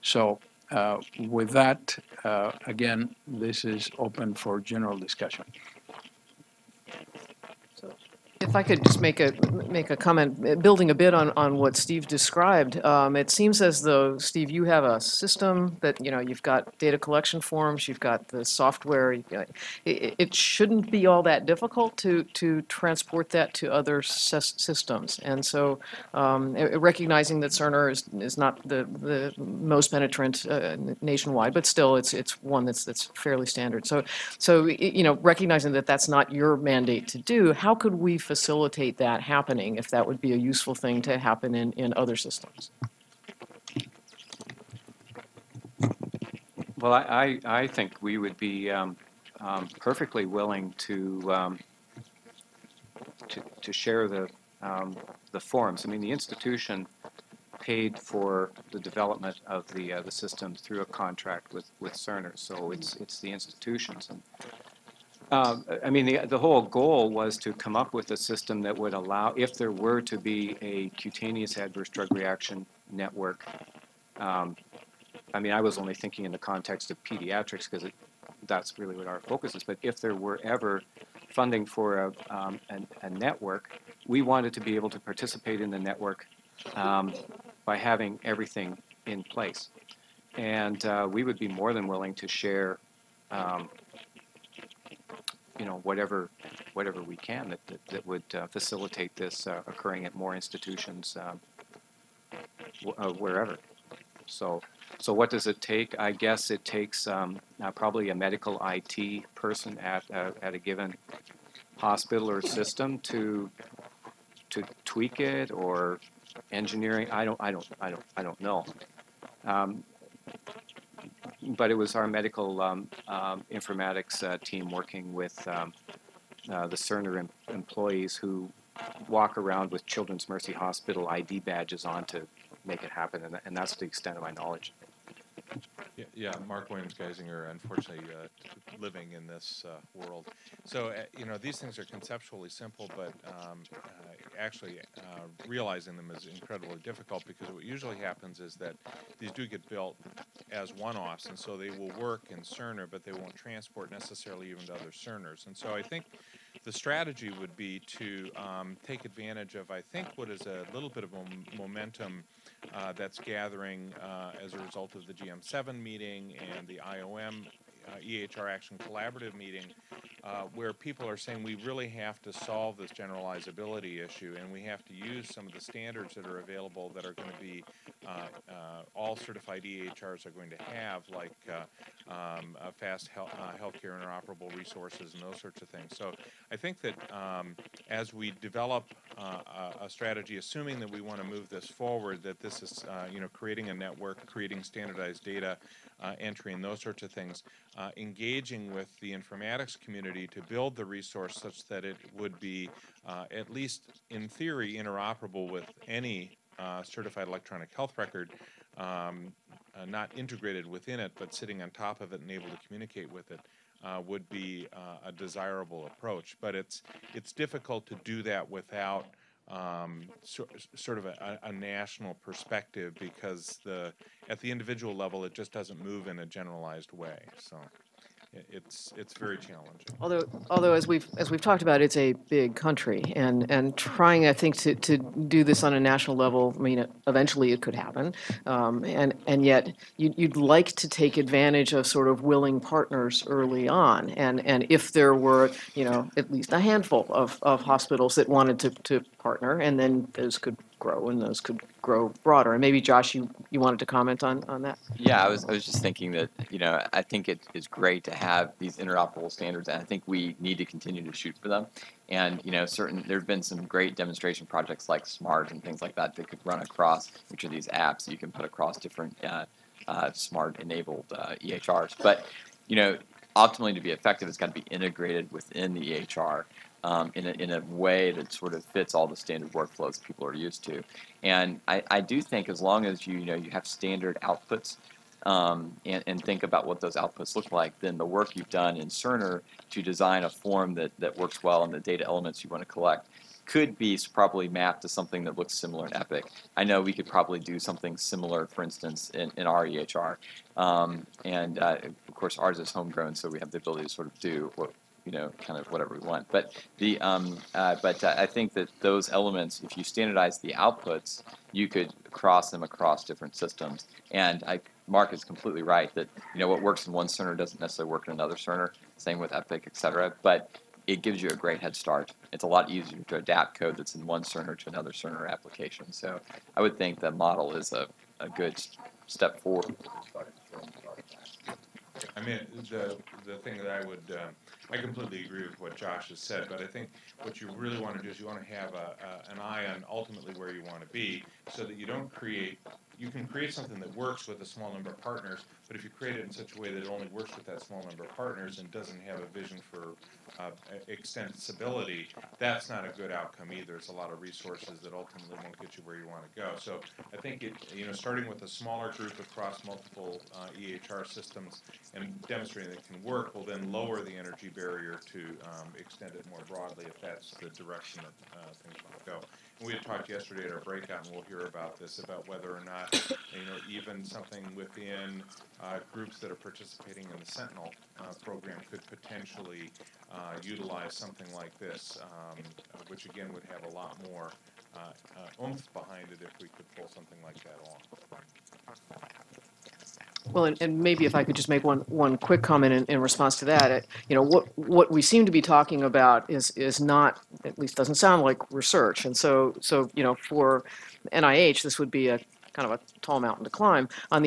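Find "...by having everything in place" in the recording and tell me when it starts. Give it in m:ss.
1:27.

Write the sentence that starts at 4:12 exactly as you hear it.
And maybe Josh, you, you wanted to comment on, on that?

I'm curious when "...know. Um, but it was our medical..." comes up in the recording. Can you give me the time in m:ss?
1:58.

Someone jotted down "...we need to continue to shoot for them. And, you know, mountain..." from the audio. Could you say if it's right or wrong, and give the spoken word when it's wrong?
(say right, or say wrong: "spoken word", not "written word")
wrong: "certain", not "mountain".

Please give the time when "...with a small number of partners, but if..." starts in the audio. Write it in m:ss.
5:44.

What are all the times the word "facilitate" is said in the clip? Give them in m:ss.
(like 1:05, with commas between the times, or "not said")
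0:38, 1:38.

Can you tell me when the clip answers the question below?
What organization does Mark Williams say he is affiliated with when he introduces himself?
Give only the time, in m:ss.
2:16.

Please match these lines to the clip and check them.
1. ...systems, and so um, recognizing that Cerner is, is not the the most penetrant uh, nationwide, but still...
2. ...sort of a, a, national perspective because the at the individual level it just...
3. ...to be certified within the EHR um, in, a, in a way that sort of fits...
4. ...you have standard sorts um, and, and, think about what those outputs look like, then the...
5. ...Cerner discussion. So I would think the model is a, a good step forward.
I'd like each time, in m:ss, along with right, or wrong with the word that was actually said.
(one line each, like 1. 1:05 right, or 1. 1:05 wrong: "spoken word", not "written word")
1. 0:24 right
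2. 3:40 right
3. 4:34 wrong: "integrated", not "certified"
4. 4:43 wrong: "outputs", not "sorts"
5. 5:24 wrong: "application", not "discussion".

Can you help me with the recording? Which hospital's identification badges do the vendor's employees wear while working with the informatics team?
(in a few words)
Children's Mercy Hospital.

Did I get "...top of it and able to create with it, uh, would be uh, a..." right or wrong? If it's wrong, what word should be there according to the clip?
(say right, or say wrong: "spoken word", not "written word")
wrong: "communicate", not "create".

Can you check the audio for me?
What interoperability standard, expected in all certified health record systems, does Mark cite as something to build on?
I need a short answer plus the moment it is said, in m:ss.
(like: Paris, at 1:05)
Fast Healthcare Interoperable Resources, at 3:02.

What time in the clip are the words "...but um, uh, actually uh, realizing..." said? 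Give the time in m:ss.
2:22.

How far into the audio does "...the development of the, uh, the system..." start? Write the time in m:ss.
0:58.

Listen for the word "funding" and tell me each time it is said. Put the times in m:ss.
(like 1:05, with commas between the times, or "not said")
1:21.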